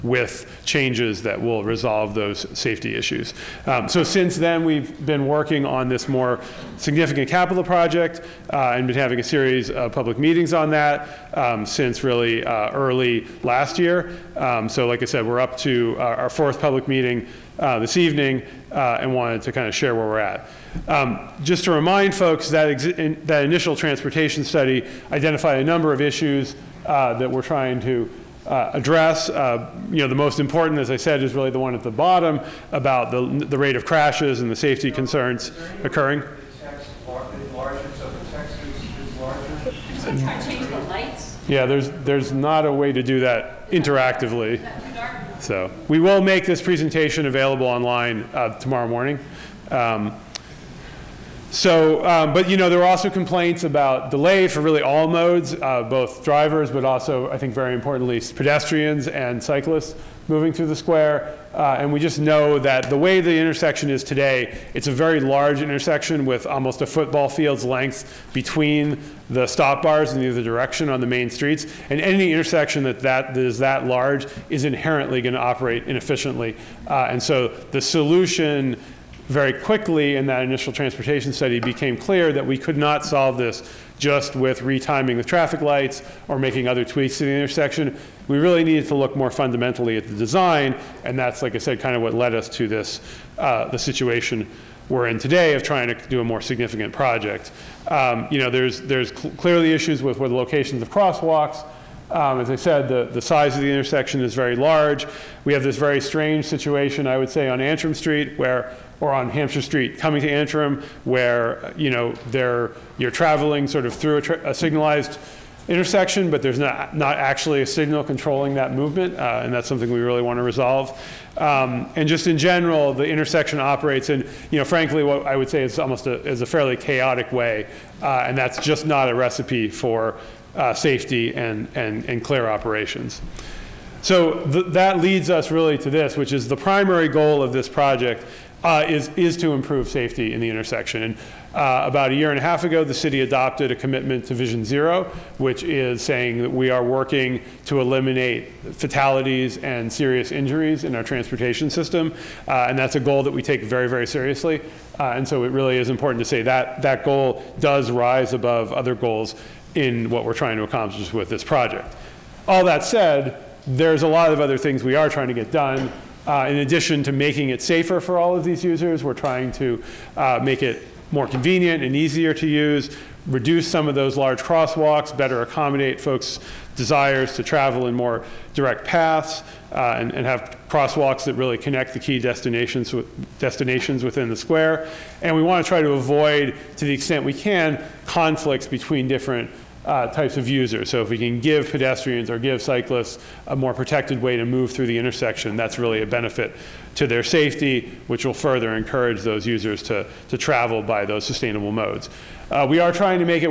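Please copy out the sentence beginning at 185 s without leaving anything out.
And we want to try to avoid, to the extent we can, conflicts between different uh, types of users.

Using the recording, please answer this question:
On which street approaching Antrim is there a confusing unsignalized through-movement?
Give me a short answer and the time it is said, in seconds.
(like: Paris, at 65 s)
Hampshire Street, at 109 s.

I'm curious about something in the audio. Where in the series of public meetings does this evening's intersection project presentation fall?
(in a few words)
fourth.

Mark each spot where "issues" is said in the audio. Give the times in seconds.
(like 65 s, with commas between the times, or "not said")
2 s, 26 s, 99 s.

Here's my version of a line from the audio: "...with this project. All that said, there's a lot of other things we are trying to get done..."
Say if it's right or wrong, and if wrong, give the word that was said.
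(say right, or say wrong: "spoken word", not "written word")
right.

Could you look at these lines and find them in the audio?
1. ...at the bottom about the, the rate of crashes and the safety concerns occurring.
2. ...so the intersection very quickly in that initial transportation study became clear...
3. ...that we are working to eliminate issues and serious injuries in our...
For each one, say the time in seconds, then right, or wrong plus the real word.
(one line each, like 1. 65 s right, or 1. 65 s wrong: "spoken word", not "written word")
1. 31 s right
2. 77 s wrong: "solution", not "intersection"
3. 146 s wrong: "fatalities", not "issues".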